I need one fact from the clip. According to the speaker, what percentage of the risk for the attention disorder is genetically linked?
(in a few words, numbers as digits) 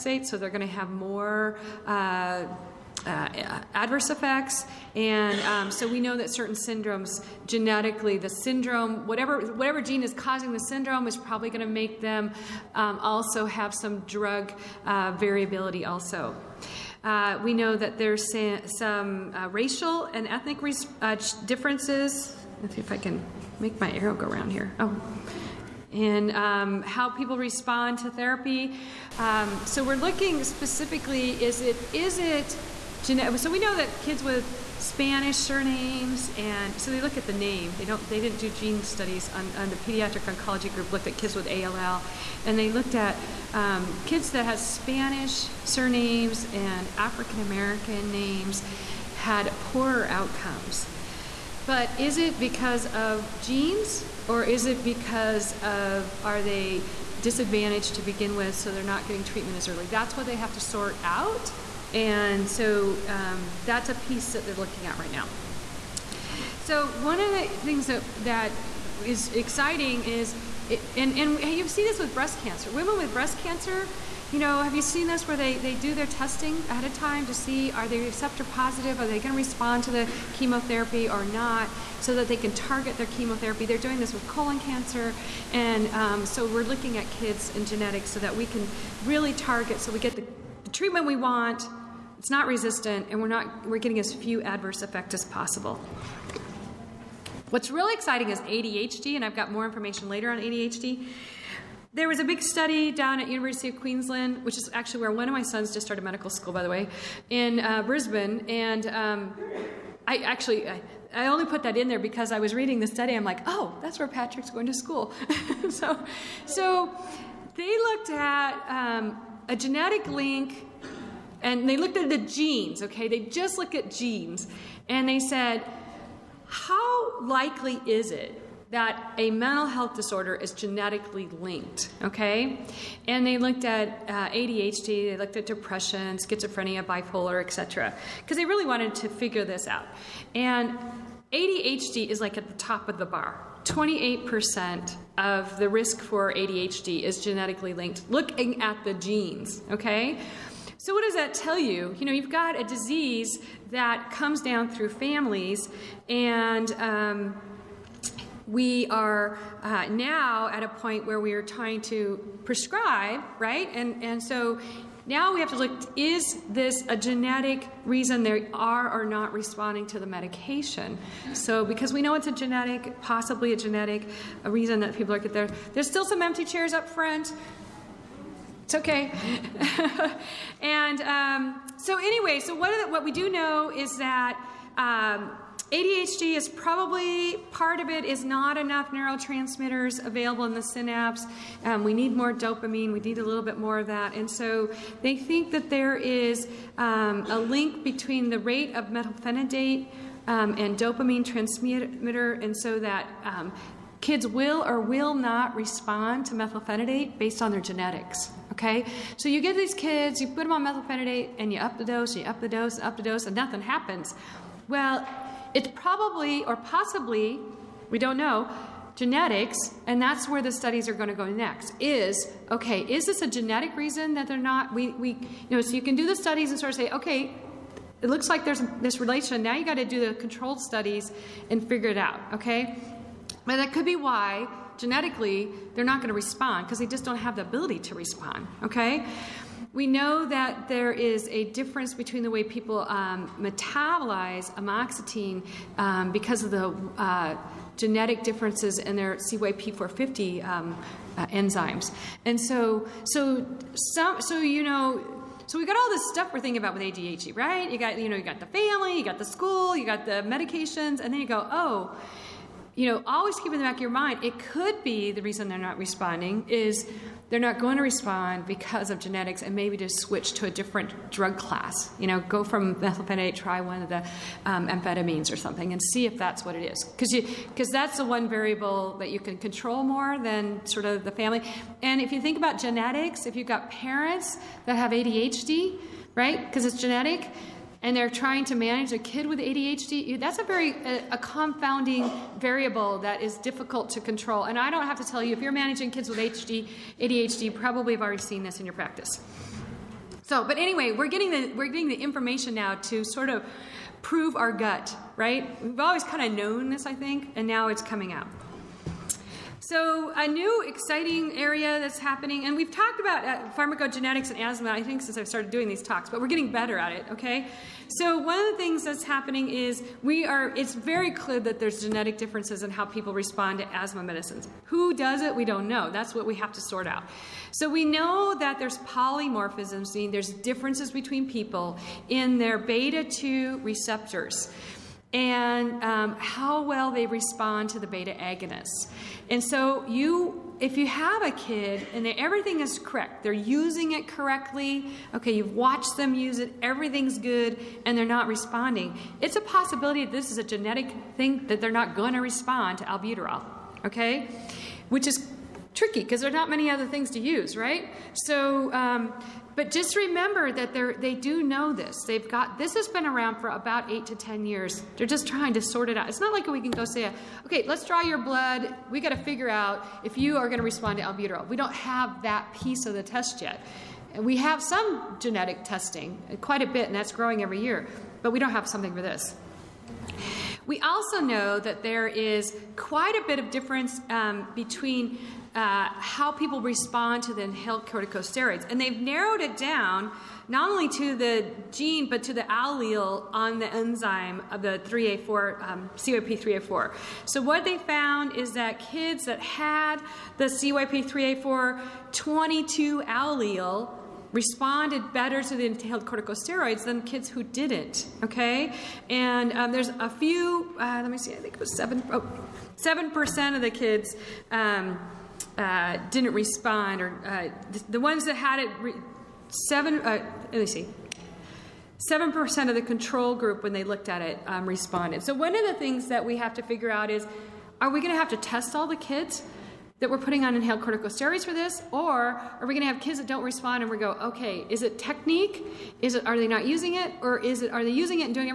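28%.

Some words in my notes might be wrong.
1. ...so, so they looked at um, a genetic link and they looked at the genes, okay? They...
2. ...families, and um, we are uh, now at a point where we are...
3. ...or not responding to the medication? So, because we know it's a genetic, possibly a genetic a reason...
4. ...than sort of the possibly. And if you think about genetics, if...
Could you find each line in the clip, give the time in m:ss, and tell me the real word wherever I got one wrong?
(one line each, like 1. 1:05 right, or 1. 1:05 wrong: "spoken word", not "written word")
1. 1:55 right
2. 2:34 right
3. 2:48 right
4. 4:40 wrong: "family", not "possibly".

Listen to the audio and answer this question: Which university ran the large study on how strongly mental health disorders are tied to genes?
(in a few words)
University of Queensland.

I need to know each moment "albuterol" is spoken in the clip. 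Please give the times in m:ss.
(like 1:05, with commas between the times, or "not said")
5:52, 6:11.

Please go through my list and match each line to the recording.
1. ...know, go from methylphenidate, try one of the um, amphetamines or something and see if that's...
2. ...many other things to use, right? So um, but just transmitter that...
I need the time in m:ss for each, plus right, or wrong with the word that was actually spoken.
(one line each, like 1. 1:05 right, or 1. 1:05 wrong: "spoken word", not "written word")
1. 4:32 right
2. 5:56 wrong: "remember", not "transmitter".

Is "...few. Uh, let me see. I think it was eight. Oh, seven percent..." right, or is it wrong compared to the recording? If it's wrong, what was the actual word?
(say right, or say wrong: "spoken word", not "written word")
wrong: "seven", not "eight".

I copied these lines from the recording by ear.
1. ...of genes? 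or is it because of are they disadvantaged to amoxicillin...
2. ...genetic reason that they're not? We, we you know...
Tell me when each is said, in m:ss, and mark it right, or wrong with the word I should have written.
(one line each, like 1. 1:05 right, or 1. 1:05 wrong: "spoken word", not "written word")
1. 0:52 wrong: "begin", not "amoxicillin"
2. 3:43 right.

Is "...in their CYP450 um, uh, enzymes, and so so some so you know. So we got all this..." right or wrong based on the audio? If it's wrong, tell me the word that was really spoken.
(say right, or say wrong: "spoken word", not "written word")
right.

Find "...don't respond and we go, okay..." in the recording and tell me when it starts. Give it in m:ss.
7:13.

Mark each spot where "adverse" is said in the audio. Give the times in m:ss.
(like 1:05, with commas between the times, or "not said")
0:03, 1:34.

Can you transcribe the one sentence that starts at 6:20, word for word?
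We also know that there is quite a bit of difference um, between uh, how people respond to the inhaled corticosteroids.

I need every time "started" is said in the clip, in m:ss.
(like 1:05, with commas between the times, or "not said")
1:45, 5:15.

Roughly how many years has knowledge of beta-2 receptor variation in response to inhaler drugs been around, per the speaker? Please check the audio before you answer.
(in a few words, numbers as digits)
8 to 10 years.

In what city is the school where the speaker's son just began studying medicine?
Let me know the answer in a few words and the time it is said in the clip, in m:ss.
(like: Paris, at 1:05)
Brisbane, at 1:47.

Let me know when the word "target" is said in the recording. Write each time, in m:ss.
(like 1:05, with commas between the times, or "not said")
1:22, 1:29.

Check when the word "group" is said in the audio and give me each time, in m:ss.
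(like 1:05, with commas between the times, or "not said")
0:40, 7:03.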